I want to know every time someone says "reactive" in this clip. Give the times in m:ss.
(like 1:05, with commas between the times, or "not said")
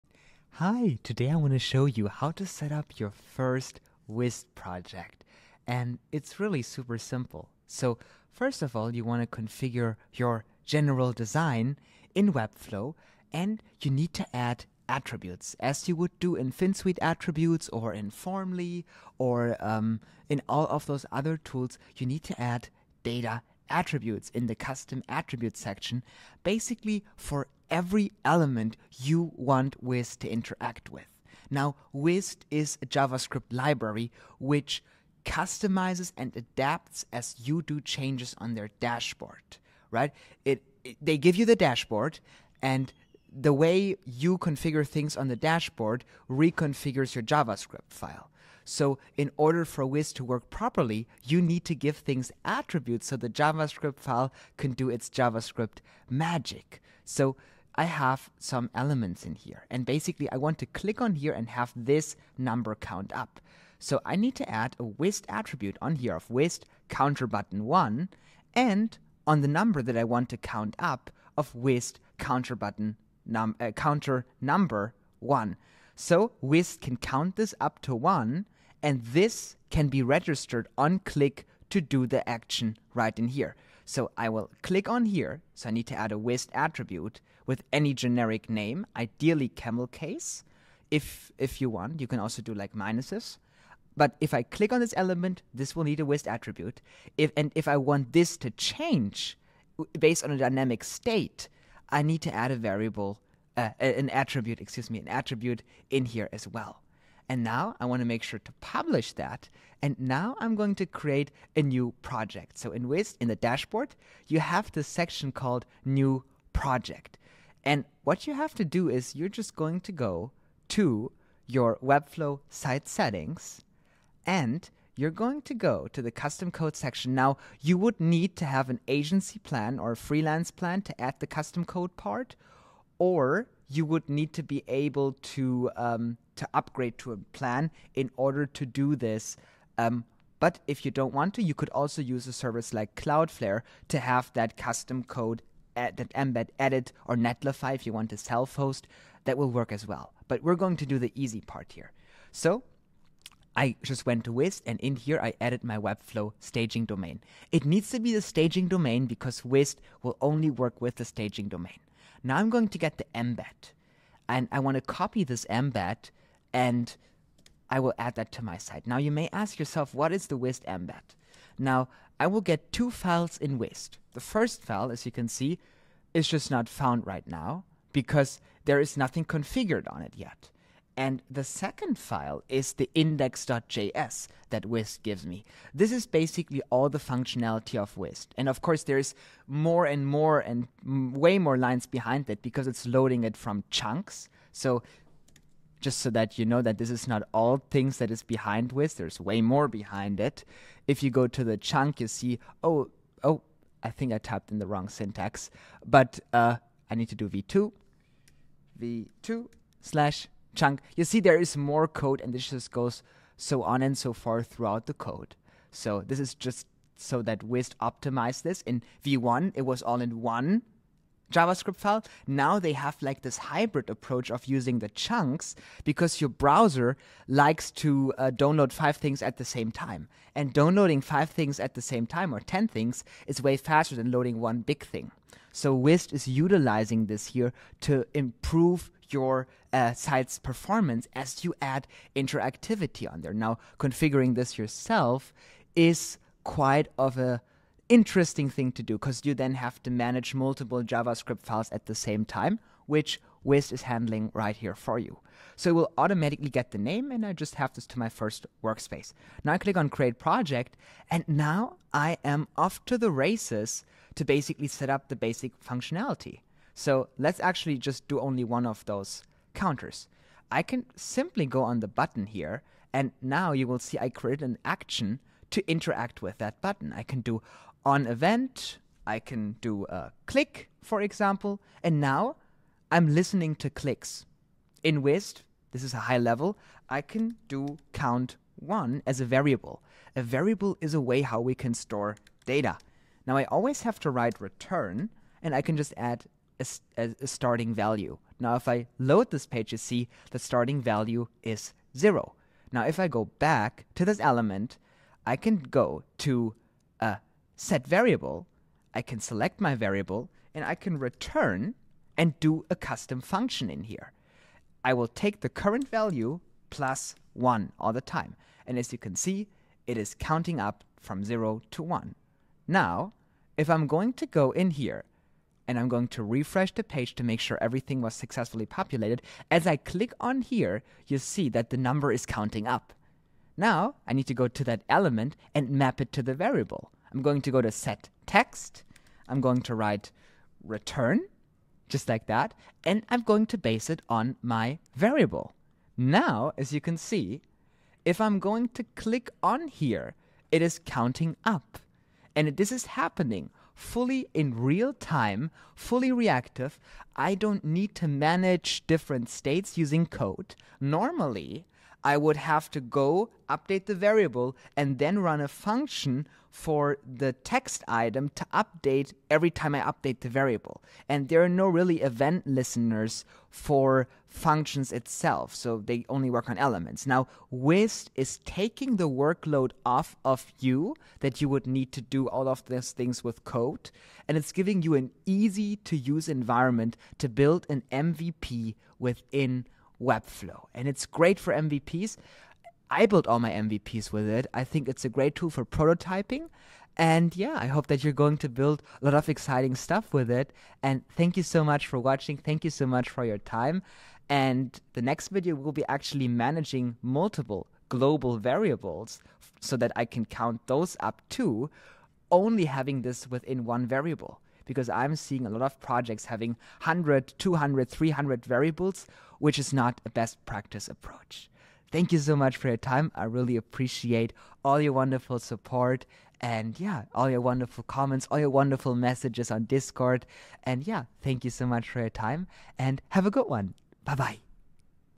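5:56.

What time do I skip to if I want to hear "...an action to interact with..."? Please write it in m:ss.
4:34.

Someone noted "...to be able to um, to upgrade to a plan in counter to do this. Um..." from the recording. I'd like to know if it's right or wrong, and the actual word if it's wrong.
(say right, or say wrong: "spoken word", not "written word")
wrong: "order", not "counter".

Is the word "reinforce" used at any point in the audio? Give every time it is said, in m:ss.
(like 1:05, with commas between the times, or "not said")
not said.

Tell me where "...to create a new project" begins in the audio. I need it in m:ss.
1:50.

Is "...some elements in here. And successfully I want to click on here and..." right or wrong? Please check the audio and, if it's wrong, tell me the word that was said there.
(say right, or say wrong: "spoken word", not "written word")
wrong: "basically", not "successfully".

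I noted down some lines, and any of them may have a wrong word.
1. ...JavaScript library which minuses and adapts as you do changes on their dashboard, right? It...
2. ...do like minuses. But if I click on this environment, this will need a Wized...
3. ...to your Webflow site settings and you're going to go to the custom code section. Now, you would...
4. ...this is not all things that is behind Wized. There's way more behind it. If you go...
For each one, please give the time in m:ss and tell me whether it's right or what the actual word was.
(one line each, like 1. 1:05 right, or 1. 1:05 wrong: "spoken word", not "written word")
1. 0:32 wrong: "customizes", not "minuses"
2. 1:32 wrong: "element", not "environment"
3. 2:00 right
4. 3:16 right.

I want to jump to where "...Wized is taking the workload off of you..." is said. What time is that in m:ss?
6:17.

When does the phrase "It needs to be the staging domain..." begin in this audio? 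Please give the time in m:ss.
2:37.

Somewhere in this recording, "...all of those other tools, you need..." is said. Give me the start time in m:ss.
0:20.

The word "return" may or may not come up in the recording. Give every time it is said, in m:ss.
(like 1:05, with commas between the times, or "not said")
4:54, 5:10, 5:40.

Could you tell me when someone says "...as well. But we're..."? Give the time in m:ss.
2:29.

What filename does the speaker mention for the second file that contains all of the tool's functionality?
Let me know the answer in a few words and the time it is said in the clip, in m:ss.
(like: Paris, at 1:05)
index.js, at 3:02.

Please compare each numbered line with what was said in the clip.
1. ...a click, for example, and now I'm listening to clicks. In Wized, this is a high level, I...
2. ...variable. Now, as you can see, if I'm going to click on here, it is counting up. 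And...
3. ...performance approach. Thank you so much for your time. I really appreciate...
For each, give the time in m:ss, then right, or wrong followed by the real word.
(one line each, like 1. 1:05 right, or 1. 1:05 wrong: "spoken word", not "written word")
1. 4:39 right
2. 5:44 right
3. 7:00 wrong: "practice", not "performance".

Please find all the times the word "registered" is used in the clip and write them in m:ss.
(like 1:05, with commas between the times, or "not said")
1:20.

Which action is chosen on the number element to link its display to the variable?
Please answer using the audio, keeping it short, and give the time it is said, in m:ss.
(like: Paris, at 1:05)
set text, at 5:37.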